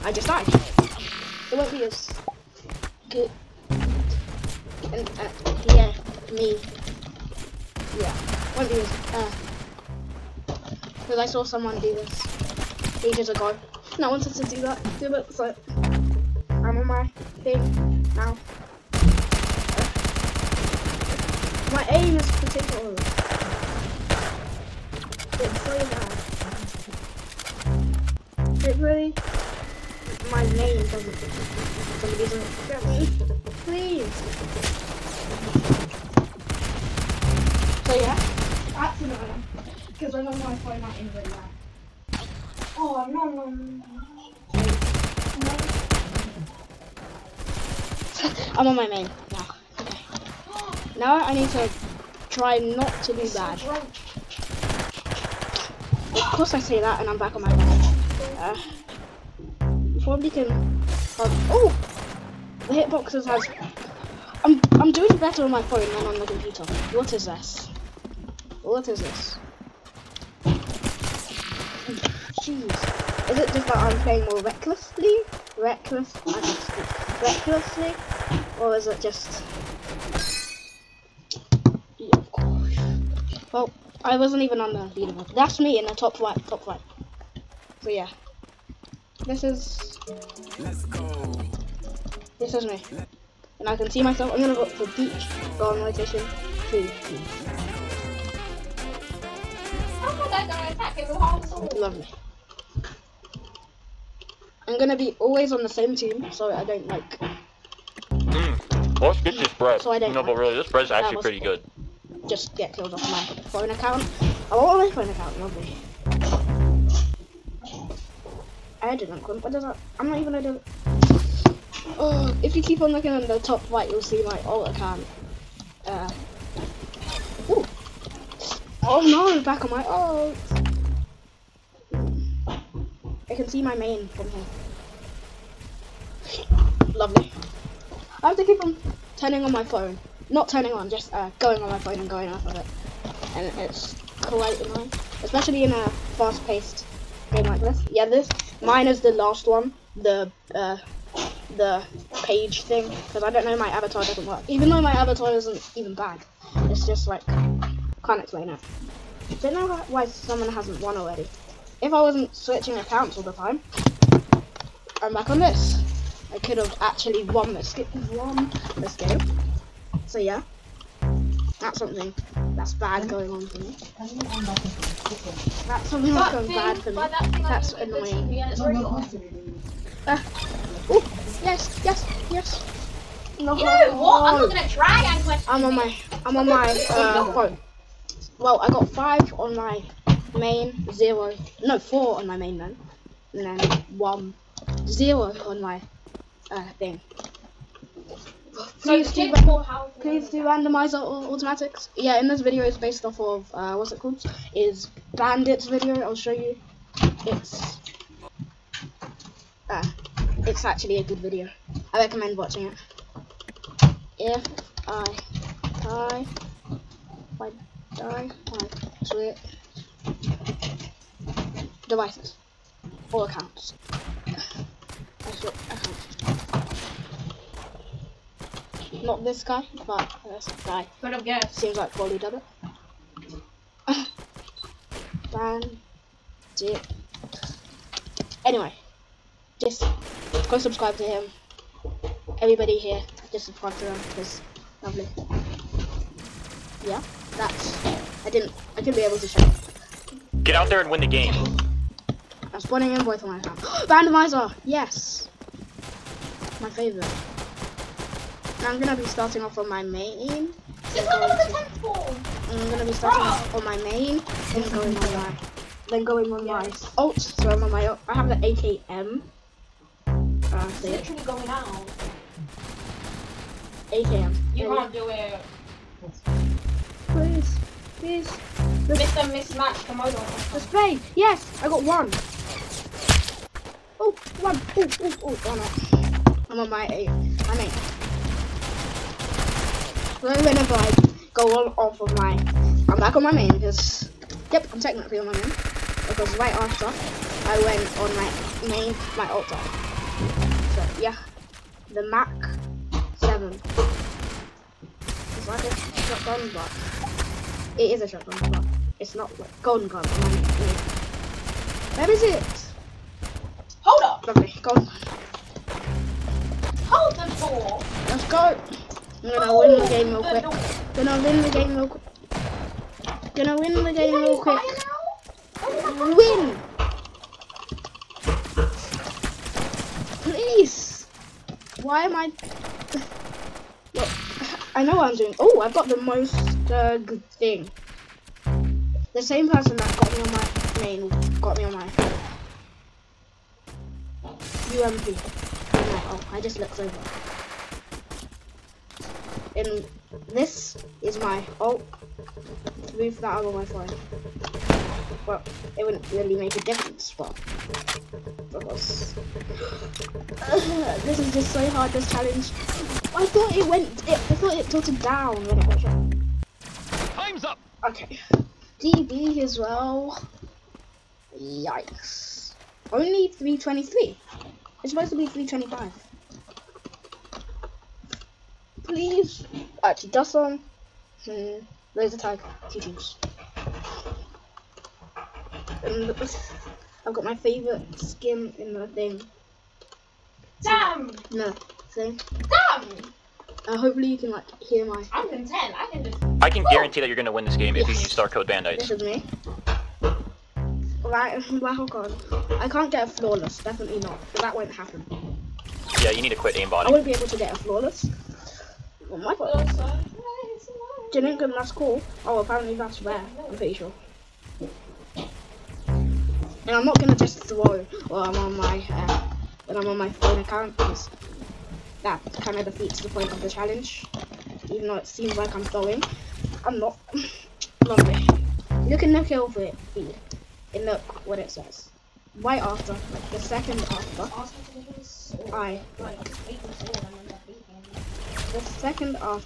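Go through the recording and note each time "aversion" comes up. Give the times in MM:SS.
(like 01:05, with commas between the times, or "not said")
not said.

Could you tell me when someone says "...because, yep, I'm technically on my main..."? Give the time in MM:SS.
04:53.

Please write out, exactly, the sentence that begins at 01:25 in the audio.
That's me in the top right, top right.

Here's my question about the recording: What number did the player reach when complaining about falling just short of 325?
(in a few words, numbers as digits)
323.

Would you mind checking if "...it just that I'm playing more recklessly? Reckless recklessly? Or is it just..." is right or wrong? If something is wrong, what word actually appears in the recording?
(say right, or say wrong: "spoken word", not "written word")
right.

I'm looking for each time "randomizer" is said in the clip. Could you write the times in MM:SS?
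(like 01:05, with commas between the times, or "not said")
03:20, 04:13.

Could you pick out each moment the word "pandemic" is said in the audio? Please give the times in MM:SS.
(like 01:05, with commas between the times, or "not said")
not said.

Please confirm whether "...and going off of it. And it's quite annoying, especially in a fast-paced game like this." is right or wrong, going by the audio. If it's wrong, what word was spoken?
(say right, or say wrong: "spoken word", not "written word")
right.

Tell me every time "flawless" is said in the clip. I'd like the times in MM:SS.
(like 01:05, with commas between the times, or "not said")
06:43, 06:47.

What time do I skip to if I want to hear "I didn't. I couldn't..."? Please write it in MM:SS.
04:08.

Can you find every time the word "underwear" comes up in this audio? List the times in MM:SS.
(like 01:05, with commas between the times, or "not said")
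not said.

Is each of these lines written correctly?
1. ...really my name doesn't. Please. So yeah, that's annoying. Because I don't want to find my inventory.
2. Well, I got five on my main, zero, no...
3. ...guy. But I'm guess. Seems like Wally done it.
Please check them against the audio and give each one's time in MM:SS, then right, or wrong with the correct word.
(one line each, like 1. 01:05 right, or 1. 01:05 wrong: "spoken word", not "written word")
1. 00:28 right
2. 03:08 right
3. 03:50 right.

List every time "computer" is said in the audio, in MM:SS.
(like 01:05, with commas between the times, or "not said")
01:06.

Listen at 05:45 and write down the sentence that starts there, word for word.
Like, oh, I just looked over.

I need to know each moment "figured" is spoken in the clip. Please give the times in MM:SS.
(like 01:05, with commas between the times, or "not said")
not said.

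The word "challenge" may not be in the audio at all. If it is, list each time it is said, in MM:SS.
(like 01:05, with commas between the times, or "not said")
06:02, 07:03.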